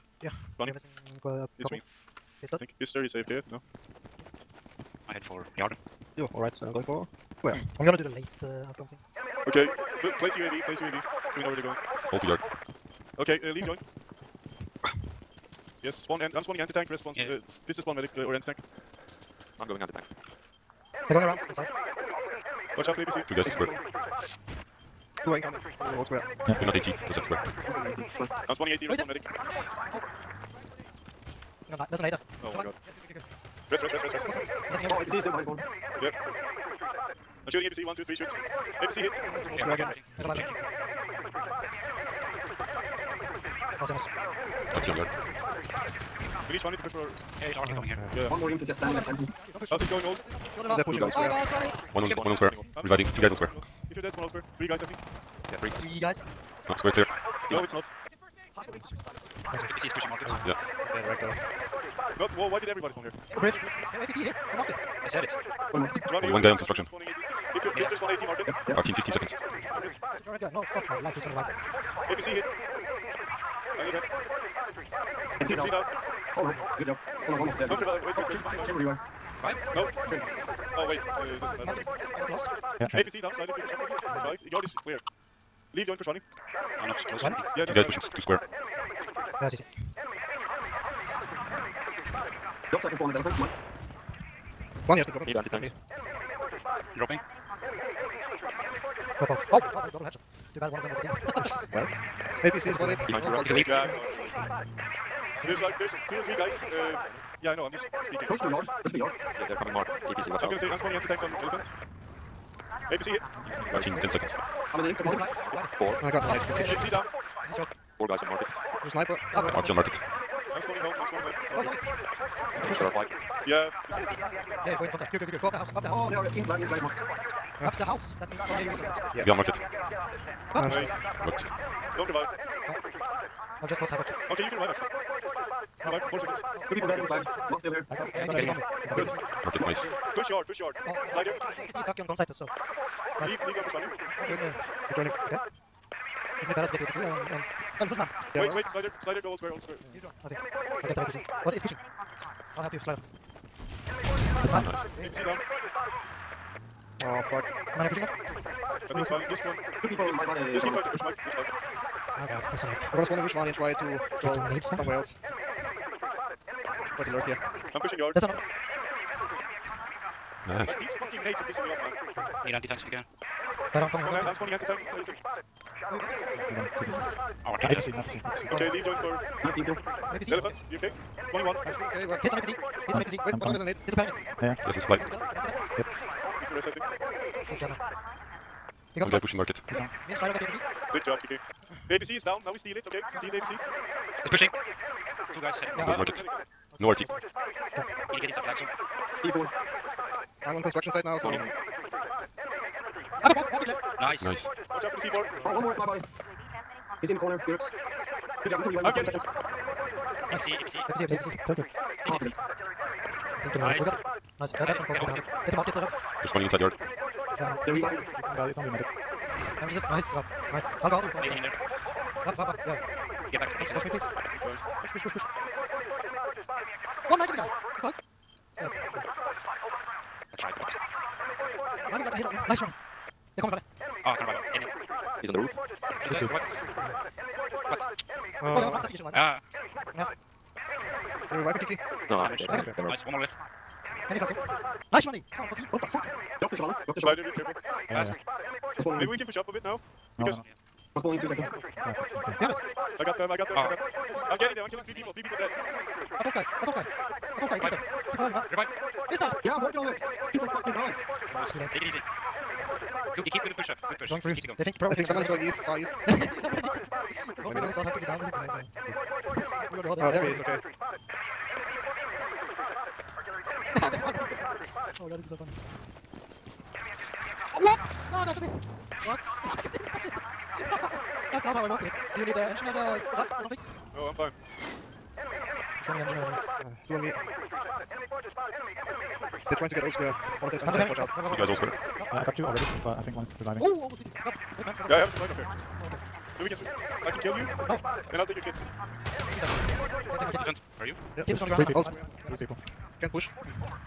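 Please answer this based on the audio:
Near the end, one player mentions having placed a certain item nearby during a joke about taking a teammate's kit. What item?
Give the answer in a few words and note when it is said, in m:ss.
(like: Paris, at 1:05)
supply drop, at 4:55.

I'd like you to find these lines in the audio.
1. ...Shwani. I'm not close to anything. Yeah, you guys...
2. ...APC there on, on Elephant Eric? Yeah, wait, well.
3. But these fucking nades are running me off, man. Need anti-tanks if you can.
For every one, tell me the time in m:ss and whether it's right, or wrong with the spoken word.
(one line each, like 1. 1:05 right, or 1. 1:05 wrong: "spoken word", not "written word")
1. 1:26 right
2. 2:26 wrong: "Man", not "Eric"
3. 2:50 wrong: "pissing", not "running".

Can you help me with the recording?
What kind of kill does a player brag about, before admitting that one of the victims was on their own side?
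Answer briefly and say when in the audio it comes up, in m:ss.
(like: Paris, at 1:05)
double headshot, at 1:39.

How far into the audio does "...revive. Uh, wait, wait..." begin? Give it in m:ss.
1:17.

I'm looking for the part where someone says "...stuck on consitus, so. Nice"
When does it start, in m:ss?
2:21.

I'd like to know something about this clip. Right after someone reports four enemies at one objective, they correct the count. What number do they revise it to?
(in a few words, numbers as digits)
5.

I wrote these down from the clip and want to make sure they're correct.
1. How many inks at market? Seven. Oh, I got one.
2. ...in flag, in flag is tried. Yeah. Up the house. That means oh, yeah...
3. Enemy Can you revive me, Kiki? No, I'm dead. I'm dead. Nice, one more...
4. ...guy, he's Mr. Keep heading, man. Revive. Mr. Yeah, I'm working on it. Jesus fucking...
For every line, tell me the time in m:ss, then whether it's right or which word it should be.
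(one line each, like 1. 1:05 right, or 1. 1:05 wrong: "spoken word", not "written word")
1. 1:54 wrong: "Four", not "Seven"
2. 2:06 wrong: "marked", not "tried"
3. 3:59 right
4. 4:17 wrong: "reviving", not "heading".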